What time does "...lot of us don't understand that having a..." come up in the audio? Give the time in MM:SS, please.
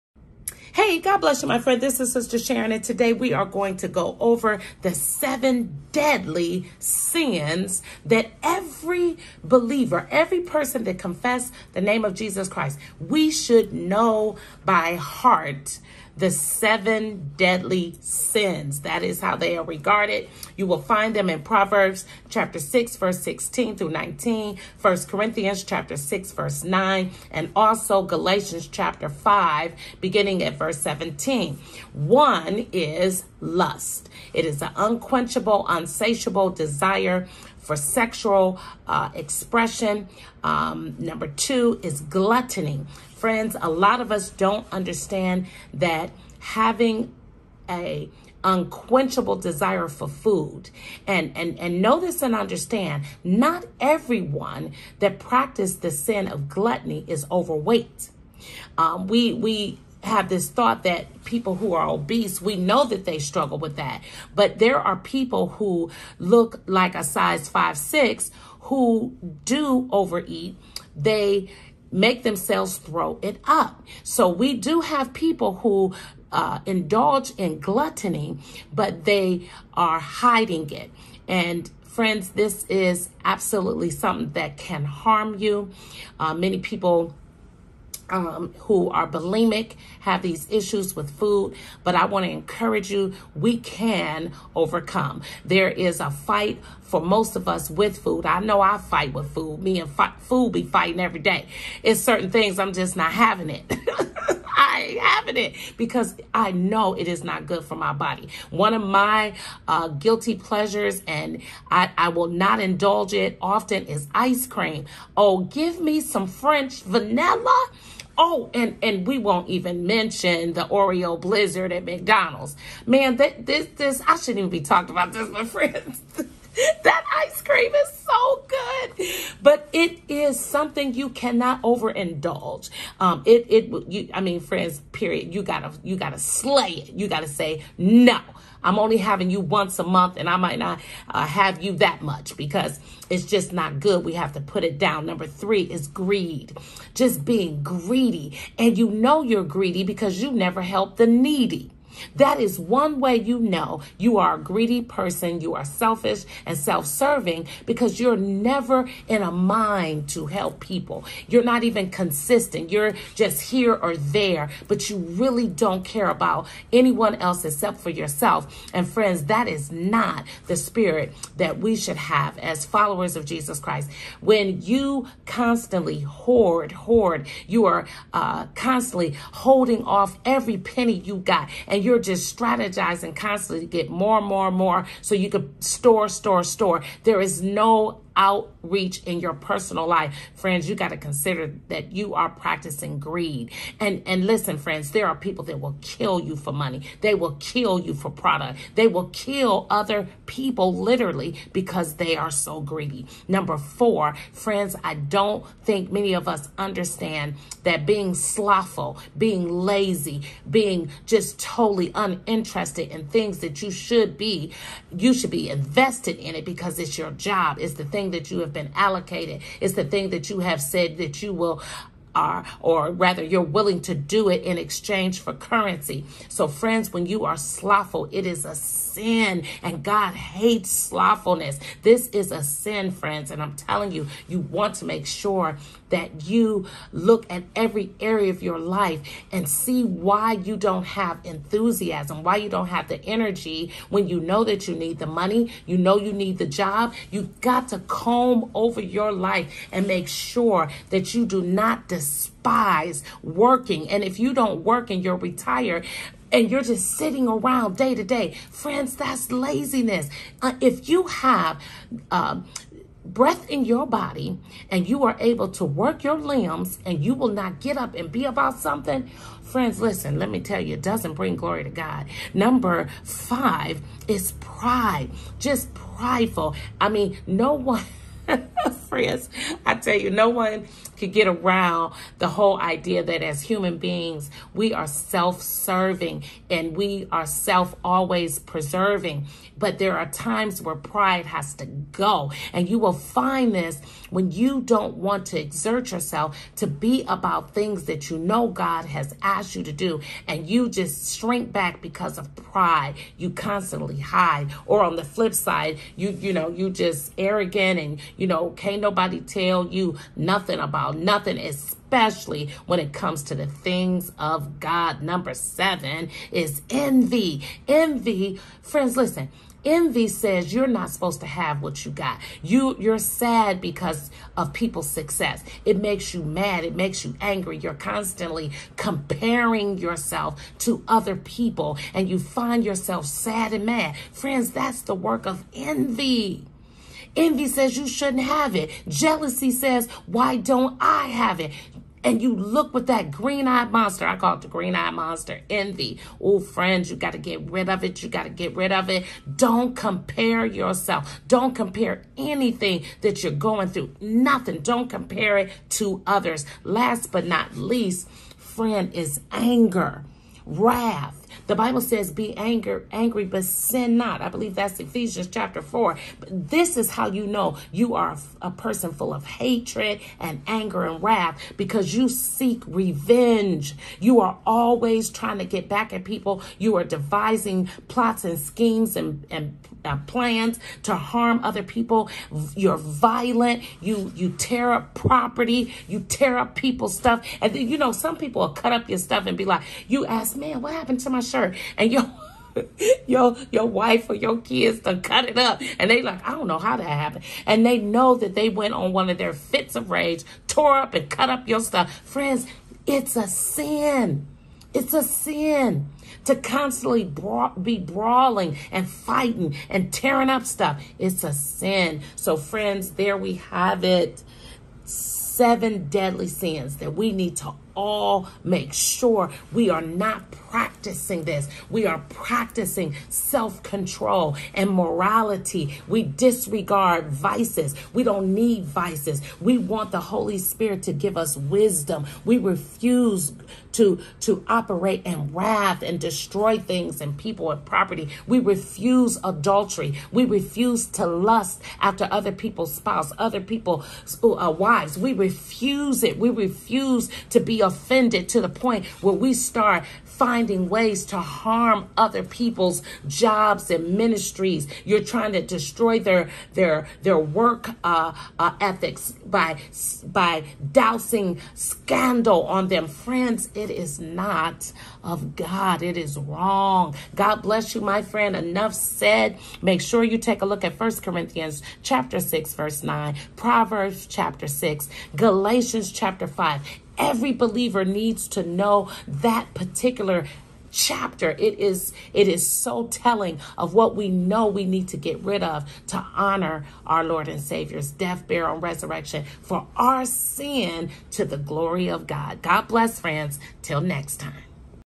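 00:43.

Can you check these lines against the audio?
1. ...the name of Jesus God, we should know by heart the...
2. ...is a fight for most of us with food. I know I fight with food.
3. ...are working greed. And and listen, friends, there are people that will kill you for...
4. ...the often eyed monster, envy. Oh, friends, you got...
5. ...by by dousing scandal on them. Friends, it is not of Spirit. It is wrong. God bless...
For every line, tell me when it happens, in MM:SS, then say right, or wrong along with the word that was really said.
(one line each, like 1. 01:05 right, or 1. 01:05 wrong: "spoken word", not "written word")
1. 00:11 wrong: "Christ", not "God"
2. 01:35 right
3. 03:12 wrong: "practicing", not "working"
4. 05:44 wrong: "green", not "often"
5. 07:39 wrong: "God", not "Spirit".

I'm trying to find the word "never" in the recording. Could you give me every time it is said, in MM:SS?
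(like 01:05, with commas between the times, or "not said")
02:30, 02:38.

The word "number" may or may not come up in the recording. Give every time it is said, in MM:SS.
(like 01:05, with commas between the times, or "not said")
00:40, 02:25, 03:23, 04:32, 05:15.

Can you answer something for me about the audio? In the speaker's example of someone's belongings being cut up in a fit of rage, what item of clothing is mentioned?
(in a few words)
Brown shirt.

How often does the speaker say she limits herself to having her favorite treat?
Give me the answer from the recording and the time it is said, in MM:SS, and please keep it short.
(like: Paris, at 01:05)
Once a month, at 02:19.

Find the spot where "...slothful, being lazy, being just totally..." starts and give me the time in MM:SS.
03:28.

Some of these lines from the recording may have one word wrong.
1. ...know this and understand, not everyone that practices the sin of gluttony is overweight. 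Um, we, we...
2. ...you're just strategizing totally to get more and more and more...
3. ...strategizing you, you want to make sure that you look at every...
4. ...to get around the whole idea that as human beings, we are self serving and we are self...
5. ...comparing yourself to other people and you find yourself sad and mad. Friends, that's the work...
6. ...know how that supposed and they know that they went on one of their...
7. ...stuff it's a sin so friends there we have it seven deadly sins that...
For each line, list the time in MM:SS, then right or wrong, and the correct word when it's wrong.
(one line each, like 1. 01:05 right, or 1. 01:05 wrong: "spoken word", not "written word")
1. 00:51 right
2. 03:01 wrong: "constantly", not "totally"
3. 03:53 wrong: "telling", not "strategizing"
4. 04:41 right
5. 05:28 right
6. 06:36 wrong: "happened", not "supposed"
7. 06:50 right.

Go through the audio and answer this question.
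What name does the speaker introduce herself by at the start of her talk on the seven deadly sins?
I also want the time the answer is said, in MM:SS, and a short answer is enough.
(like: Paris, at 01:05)
Sister Sharon, at 00:02.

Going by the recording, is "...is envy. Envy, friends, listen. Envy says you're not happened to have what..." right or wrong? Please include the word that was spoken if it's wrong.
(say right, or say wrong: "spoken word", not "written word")
wrong: "supposed", not "happened".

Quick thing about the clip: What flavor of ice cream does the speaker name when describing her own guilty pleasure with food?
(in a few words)
French vanilla.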